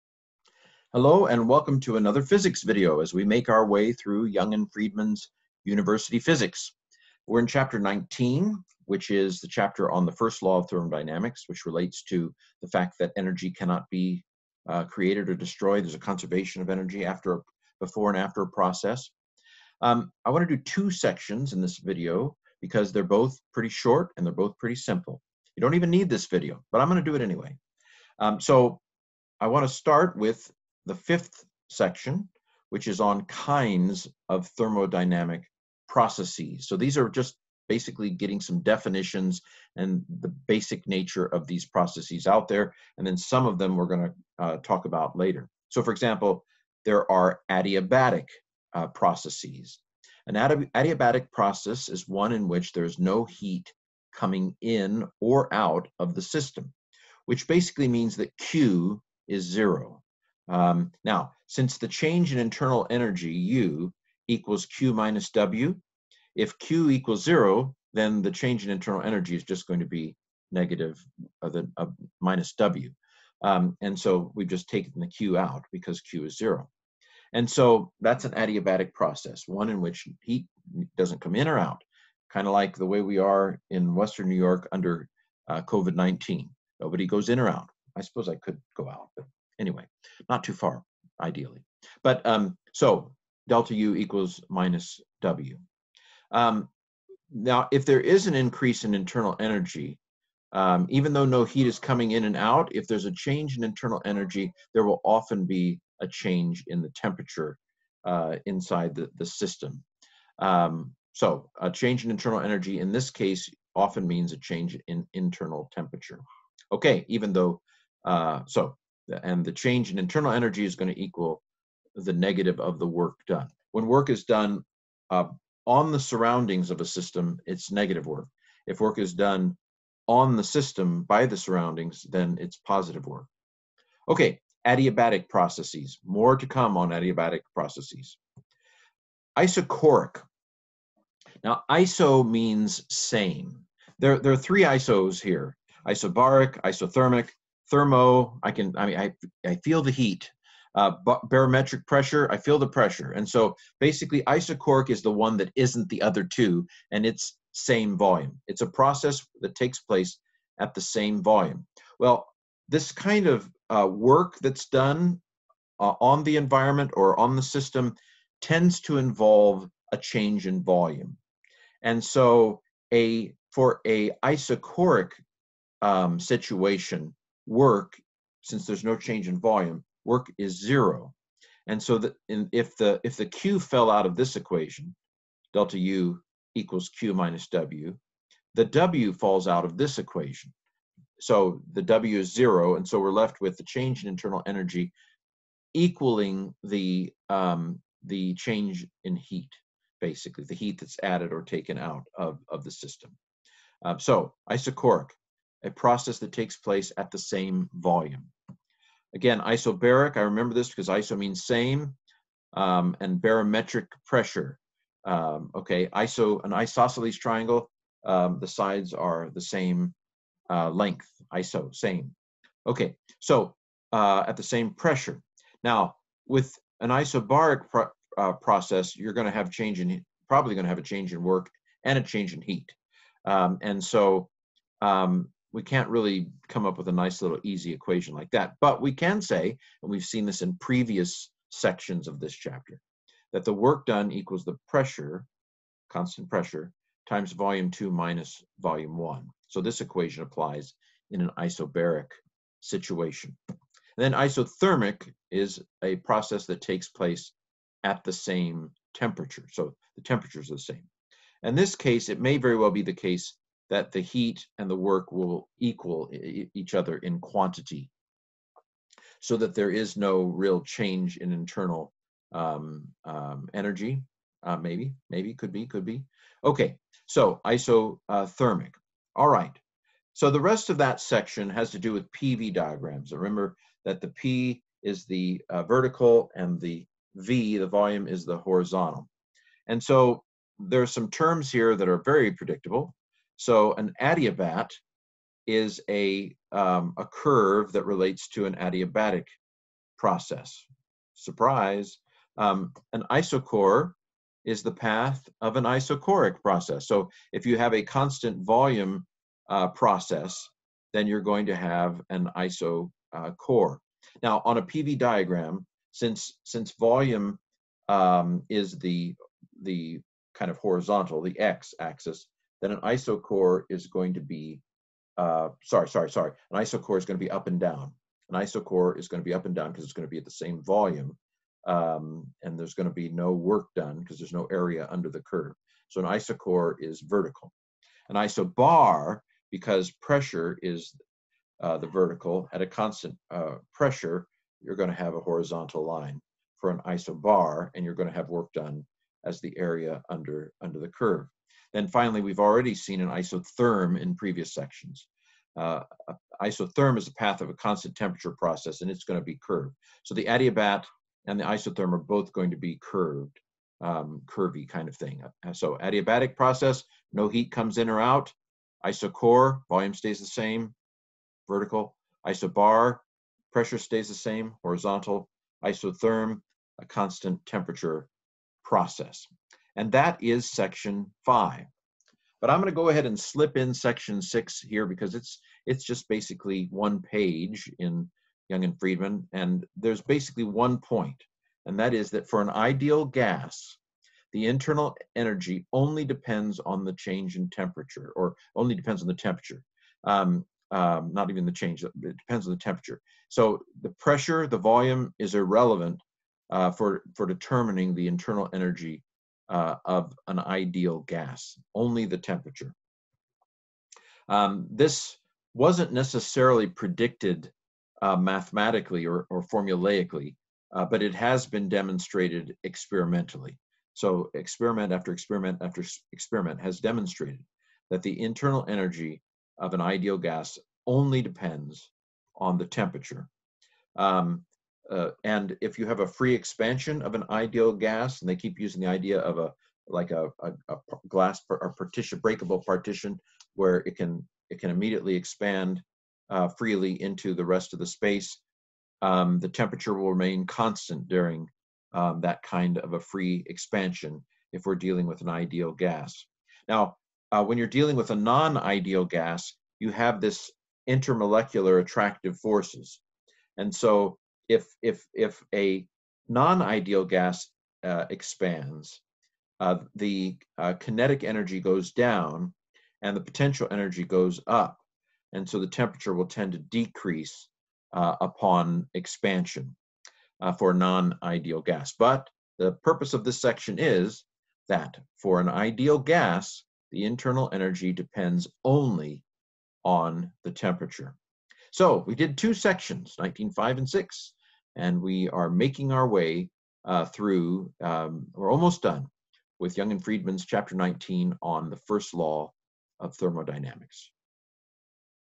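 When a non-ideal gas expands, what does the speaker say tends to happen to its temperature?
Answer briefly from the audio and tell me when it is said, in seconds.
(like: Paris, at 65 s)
decrease, at 476 s.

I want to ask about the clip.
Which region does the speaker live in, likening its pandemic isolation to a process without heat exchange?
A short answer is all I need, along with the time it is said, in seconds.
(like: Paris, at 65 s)
Western New York, at 83 s.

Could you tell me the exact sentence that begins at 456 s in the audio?
Now, uh, when you're dealing with a non-ideal gas, you have this intermolecular attractive forces.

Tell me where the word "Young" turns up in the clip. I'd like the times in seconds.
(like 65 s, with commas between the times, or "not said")
4 s, 388 s, 499 s.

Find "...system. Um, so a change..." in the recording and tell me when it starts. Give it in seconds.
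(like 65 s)
109 s.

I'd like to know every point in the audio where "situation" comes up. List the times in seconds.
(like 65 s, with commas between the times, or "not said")
176 s, 252 s.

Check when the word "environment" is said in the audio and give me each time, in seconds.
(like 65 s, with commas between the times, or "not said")
166 s.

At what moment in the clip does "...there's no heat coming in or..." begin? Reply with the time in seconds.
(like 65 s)
52 s.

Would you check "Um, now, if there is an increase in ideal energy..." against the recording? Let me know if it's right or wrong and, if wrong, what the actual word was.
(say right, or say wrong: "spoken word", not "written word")
wrong: "internal", not "ideal".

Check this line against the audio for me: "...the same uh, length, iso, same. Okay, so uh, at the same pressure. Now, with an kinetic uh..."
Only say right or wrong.
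wrong.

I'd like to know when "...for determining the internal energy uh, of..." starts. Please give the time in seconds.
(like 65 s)
407 s.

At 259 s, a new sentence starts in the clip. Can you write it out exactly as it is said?
So the temperatures are the same.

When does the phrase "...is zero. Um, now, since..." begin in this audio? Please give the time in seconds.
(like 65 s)
59 s.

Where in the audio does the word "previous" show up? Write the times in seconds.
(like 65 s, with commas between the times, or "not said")
240 s, 354 s.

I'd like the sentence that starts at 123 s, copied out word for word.
When work is done uh, on the surroundings of a system, it's negative work.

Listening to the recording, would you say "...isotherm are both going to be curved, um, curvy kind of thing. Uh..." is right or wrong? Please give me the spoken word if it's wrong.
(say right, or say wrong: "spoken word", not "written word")
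right.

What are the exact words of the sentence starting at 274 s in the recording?
Uh, maybe, maybe, could be, could be.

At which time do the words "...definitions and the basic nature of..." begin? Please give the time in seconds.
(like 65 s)
38 s.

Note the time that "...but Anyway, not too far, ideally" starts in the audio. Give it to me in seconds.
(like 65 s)
89 s.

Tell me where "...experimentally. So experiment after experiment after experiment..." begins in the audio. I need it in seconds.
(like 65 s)
422 s.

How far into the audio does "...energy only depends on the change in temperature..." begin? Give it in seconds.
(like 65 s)
395 s.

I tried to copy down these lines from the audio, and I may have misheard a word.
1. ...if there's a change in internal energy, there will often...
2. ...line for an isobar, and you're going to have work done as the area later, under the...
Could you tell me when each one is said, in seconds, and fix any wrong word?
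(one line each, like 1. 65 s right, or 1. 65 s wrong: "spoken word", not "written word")
1. 102 s right
2. 345 s wrong: "under", not "later".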